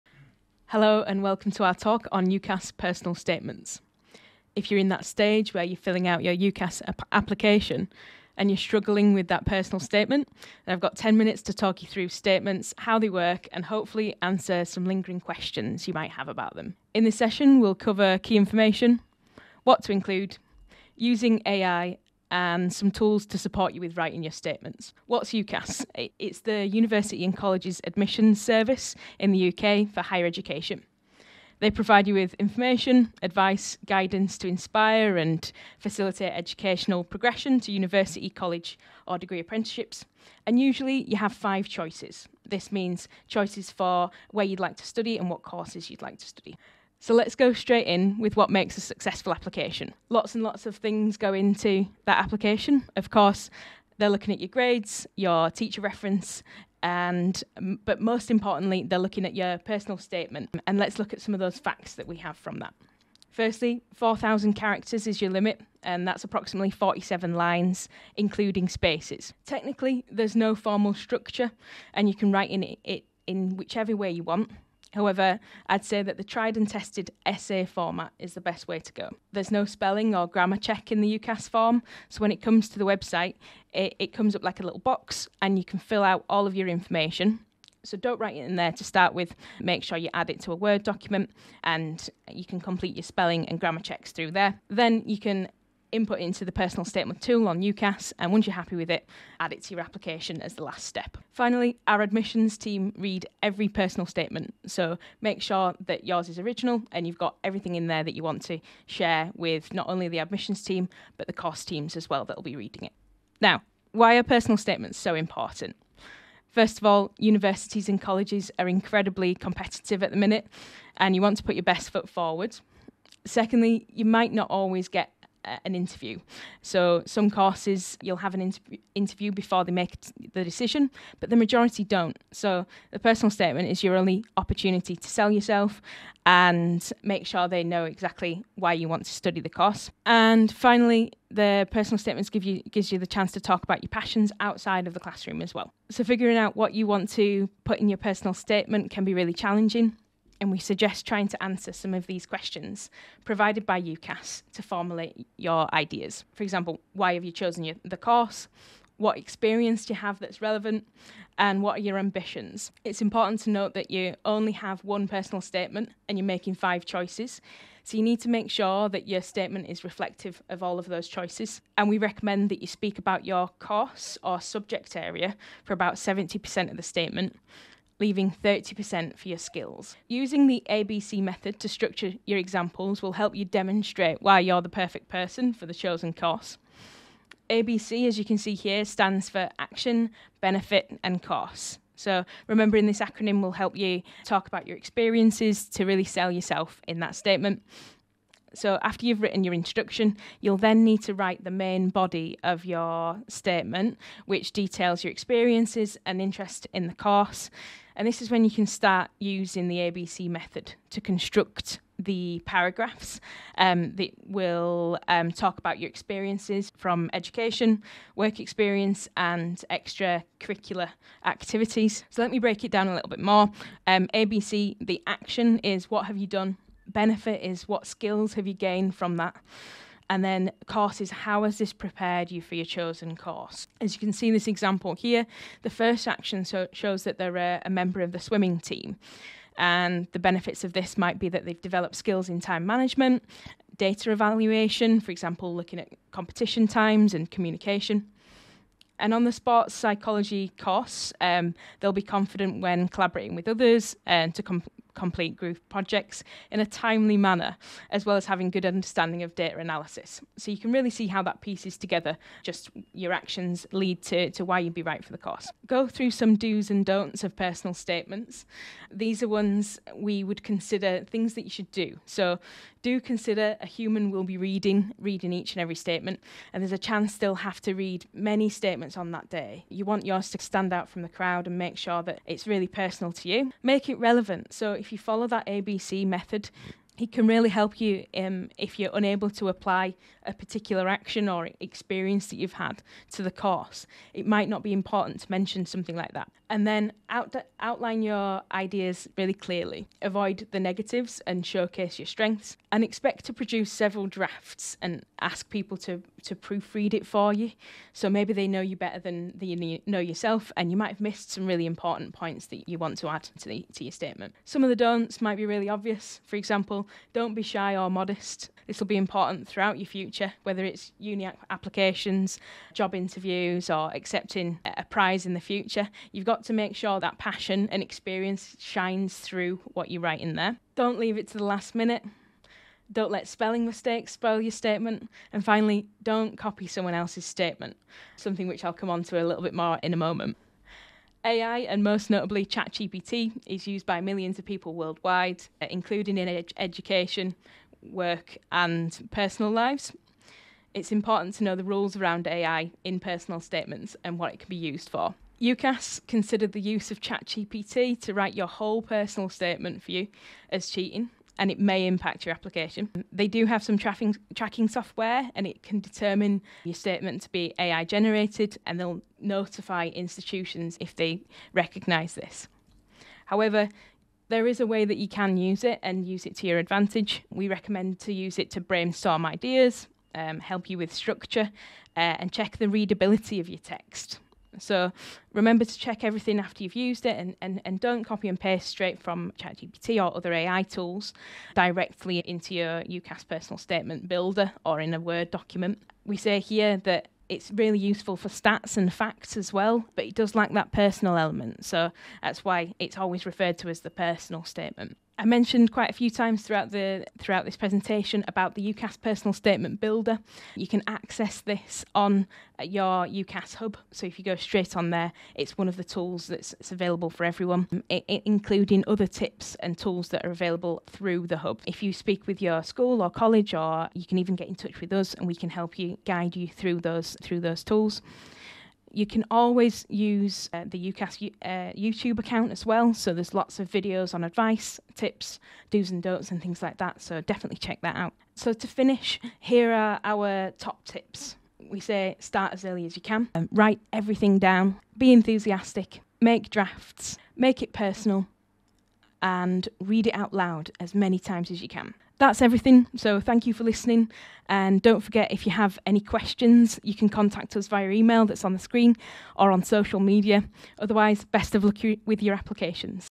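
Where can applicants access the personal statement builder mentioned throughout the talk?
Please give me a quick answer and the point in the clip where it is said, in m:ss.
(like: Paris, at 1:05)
UCAS hub, at 6:53.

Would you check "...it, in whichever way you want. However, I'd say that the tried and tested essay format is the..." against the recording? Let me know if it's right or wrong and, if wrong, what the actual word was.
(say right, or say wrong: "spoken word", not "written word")
right.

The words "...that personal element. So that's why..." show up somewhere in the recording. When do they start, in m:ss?
6:40.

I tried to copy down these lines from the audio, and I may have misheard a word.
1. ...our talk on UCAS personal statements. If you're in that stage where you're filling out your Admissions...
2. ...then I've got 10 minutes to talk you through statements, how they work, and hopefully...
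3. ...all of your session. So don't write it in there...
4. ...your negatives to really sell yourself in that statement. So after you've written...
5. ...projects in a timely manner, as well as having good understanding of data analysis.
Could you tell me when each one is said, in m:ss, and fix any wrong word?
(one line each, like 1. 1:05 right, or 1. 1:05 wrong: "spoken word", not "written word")
1. 0:01 wrong: "UCAS", not "Admissions"
2. 0:10 right
3. 1:26 wrong: "information", not "session"
4. 3:14 wrong: "experiences", not "negatives"
5. 4:15 right.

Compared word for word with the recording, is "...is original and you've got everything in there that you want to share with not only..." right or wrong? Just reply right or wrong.
right.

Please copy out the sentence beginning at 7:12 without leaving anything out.
So there's lots of videos on advice, tips, do's and don'ts, and things like that.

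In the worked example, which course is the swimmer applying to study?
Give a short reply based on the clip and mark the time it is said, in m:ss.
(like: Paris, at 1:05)
sports psychology, at 4:09.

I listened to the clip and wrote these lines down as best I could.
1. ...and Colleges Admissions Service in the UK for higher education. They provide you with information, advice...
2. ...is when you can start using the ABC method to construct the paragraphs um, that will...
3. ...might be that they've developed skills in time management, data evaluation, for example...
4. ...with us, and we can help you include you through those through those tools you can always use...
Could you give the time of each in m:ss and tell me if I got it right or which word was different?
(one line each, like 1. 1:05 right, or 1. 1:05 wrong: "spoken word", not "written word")
1. 0:27 right
2. 3:28 right
3. 4:00 right
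4. 7:04 wrong: "guide", not "include".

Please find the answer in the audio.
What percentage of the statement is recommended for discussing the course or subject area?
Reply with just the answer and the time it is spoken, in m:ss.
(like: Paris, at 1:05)
70%, at 2:55.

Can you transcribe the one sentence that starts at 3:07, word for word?
ABC, as you can see here, stands for action, benefit, and cost.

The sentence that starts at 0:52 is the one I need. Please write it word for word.
Of course, they're looking at your grades, your teacher reference, and um, but most importantly, they're looking at your personal statement.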